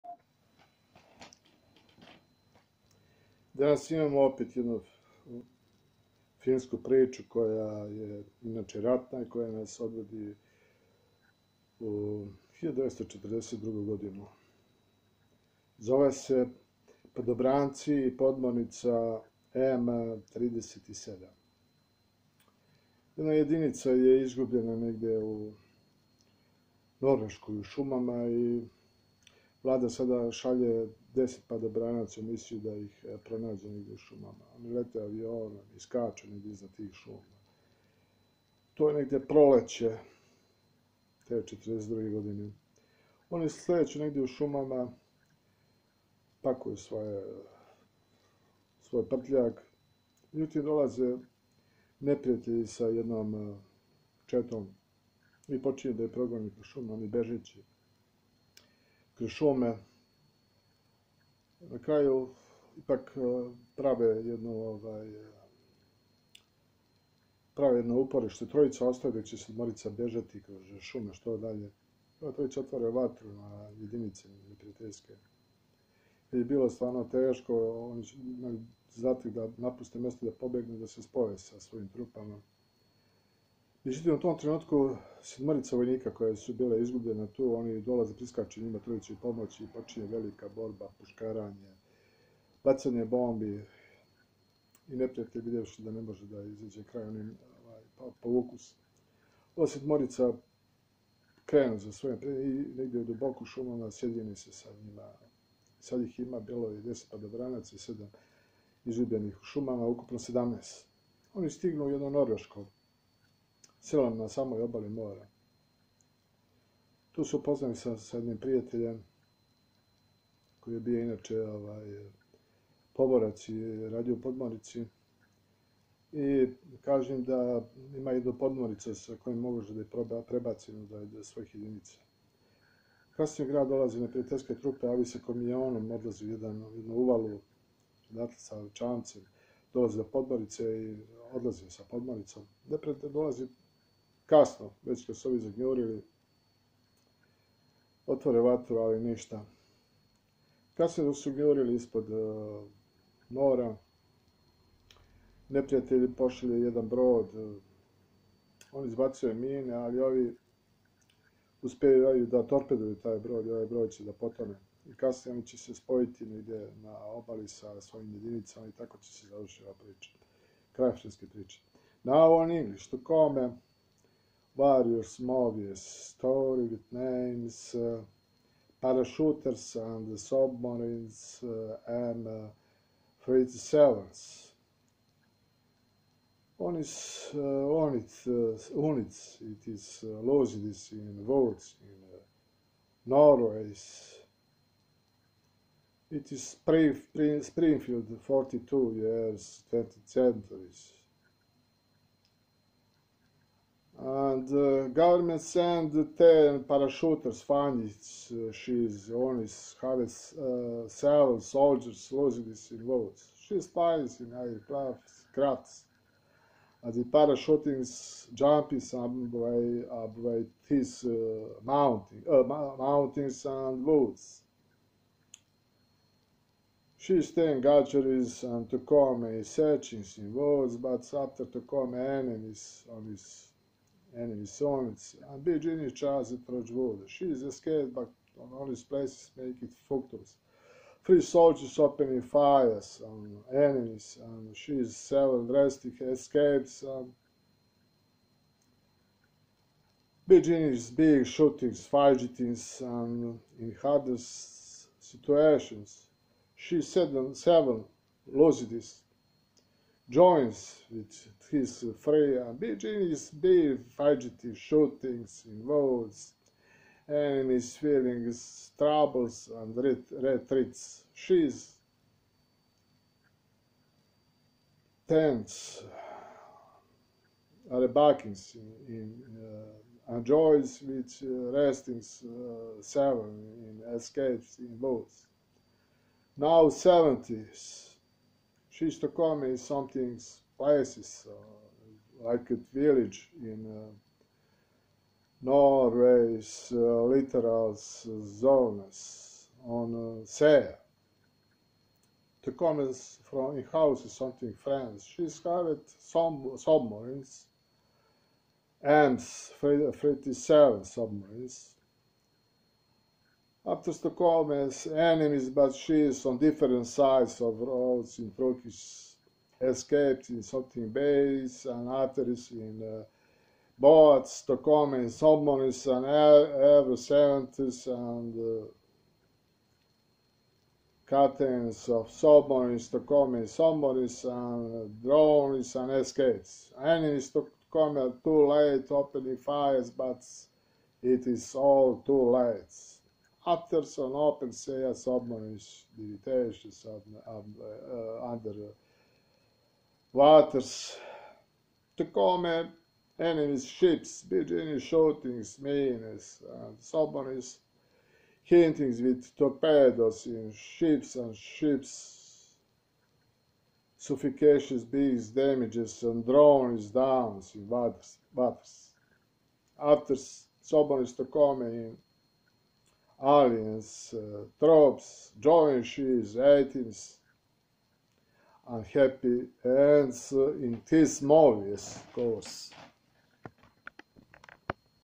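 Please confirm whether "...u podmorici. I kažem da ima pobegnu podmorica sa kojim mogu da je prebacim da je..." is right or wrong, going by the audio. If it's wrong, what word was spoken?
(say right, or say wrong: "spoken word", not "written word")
wrong: "jednu", not "pobegnu".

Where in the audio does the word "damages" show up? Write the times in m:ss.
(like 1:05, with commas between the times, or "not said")
6:05.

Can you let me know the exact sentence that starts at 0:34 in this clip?
Oni lete avionom i skaču negdje iza tih šuma.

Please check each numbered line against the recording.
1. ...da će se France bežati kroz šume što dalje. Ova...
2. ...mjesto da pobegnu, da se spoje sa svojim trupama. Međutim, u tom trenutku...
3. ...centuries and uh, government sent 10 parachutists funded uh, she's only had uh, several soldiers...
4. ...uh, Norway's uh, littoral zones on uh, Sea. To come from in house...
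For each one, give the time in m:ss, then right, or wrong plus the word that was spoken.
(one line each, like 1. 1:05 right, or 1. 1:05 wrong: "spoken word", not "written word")
1. 1:09 wrong: "Morica", not "France"
2. 1:19 right
3. 3:20 right
4. 4:53 right.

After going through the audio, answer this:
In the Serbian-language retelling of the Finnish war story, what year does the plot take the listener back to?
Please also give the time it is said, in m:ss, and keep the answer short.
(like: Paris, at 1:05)
1942, at 0:12.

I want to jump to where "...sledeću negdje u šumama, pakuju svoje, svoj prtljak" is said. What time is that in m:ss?
0:43.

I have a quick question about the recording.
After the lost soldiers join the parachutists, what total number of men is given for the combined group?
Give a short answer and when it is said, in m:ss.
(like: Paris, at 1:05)
17, at 1:50.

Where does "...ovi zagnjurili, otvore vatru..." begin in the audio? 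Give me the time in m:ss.
2:25.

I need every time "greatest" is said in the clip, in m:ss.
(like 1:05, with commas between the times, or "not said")
not said.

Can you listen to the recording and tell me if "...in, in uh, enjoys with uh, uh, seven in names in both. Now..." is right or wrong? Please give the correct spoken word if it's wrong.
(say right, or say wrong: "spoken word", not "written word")
wrong: "escapes", not "names".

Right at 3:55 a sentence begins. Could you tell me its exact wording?
and be genius as it She is escaped, but on all his places make it focus.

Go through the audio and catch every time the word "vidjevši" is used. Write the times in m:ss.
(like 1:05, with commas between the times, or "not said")
1:35.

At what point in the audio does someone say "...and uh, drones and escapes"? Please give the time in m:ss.
5:34.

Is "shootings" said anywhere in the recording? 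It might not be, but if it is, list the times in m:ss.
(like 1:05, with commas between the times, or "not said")
4:11, 4:24, 5:54.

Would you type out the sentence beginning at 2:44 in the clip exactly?
I kasnije oni će se spojiti negdje na obali sa svojim jedinicama i tako će se završiti ova priča.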